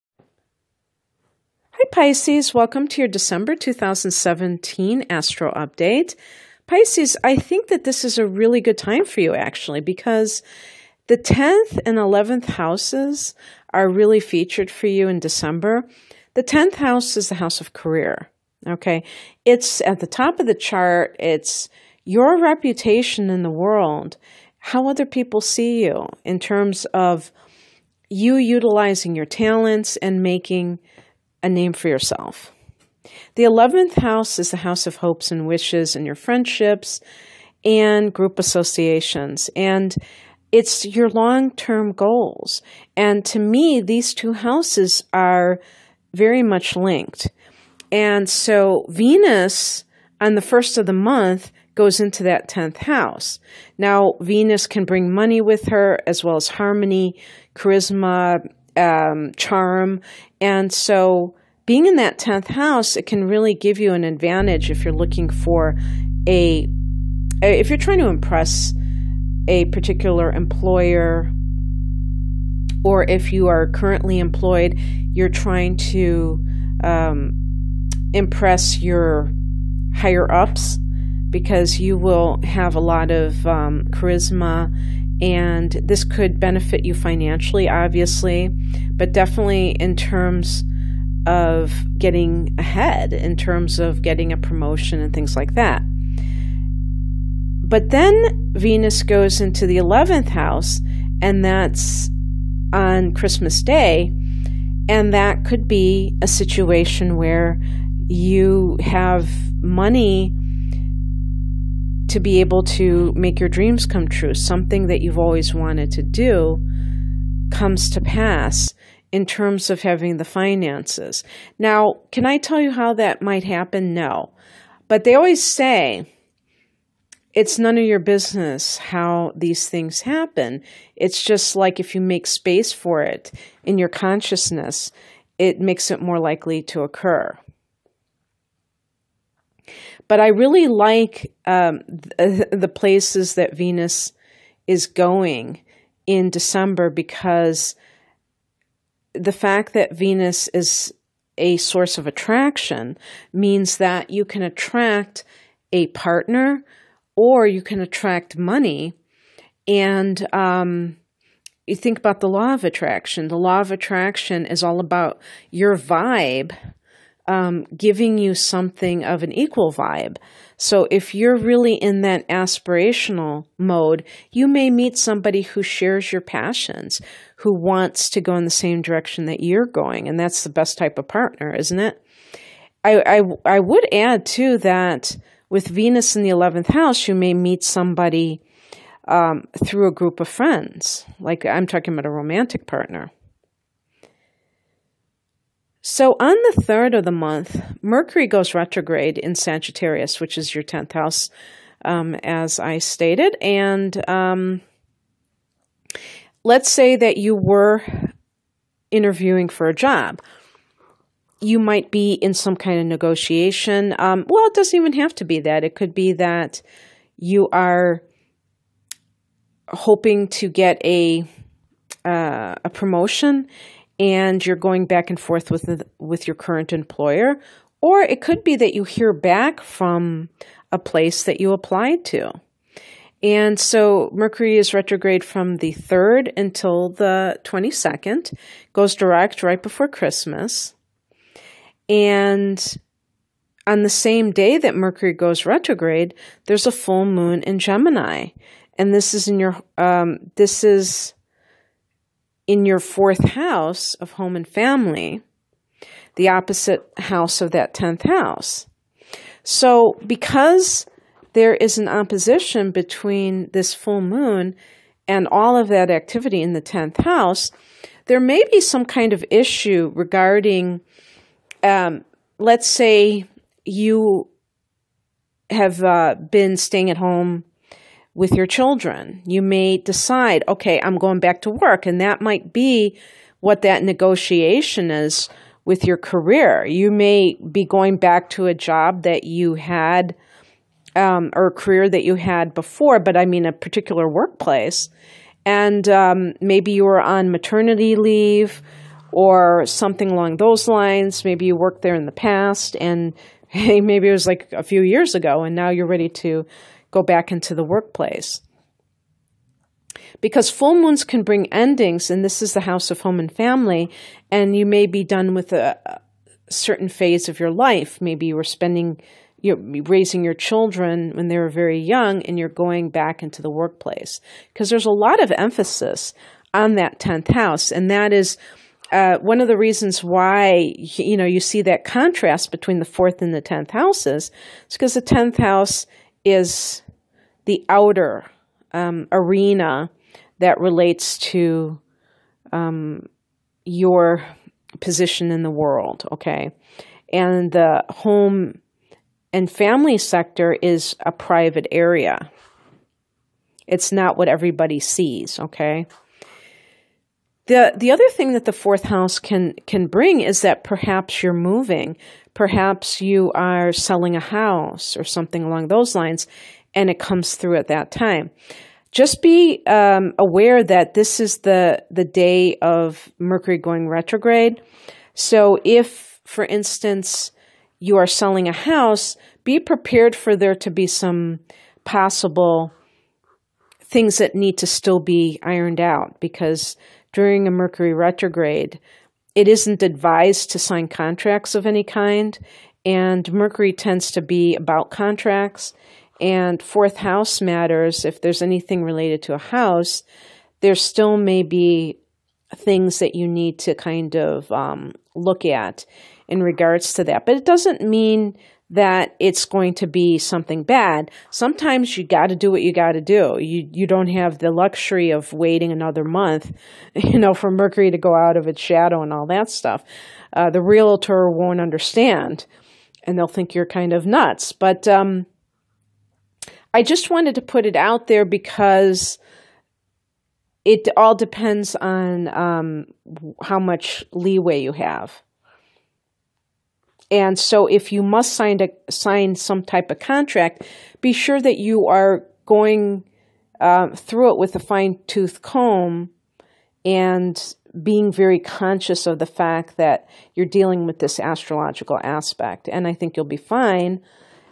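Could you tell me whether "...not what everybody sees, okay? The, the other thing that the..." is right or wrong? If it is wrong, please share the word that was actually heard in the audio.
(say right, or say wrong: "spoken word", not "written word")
right.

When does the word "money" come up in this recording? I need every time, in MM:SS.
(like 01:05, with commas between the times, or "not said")
00:55, 01:49, 02:38.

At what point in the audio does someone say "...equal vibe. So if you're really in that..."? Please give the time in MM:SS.
02:49.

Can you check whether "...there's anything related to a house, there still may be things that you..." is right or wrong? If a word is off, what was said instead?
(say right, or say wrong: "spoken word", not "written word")
right.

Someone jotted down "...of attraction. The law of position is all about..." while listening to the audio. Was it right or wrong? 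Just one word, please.
wrong.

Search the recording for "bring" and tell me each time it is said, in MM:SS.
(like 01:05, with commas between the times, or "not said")
00:54, 05:11, 05:59.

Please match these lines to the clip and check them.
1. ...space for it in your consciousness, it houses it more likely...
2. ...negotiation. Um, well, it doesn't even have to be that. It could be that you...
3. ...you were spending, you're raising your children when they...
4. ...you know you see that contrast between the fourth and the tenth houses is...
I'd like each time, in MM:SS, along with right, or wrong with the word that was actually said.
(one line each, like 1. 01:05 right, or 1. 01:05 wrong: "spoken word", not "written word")
1. 02:12 wrong: "makes", not "houses"
2. 03:32 right
3. 05:18 right
4. 05:30 right.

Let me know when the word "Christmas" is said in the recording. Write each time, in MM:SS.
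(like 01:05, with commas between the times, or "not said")
01:43, 03:59.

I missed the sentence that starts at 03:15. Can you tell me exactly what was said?
So on the third of the month, Mercury goes retrograde in Sagittarius, which is your 10th house, um, as I stated.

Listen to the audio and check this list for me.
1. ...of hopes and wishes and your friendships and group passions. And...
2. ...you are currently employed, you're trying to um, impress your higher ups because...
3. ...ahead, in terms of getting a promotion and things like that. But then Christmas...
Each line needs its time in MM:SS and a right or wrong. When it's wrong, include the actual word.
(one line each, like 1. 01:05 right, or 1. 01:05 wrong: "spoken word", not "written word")
1. 00:34 wrong: "associations", not "passions"
2. 01:13 right
3. 01:32 wrong: "Venus", not "Christmas".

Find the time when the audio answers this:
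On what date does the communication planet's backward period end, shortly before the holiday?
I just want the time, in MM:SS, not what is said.
03:56.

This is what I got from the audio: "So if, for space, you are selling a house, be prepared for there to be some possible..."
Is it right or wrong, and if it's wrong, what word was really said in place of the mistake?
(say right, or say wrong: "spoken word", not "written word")
wrong: "instance", not "space".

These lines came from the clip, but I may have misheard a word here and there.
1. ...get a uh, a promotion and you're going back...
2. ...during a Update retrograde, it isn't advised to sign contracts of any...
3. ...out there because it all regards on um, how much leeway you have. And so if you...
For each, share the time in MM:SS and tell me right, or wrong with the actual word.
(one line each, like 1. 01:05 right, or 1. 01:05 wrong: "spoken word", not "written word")
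1. 03:40 right
2. 06:27 wrong: "Mercury", not "Update"
3. 07:07 wrong: "depends", not "regards".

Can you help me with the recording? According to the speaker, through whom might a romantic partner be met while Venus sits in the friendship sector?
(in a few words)
a group of friends.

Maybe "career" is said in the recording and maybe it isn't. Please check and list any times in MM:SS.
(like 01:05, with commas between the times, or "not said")
00:17, 04:45, 04:51.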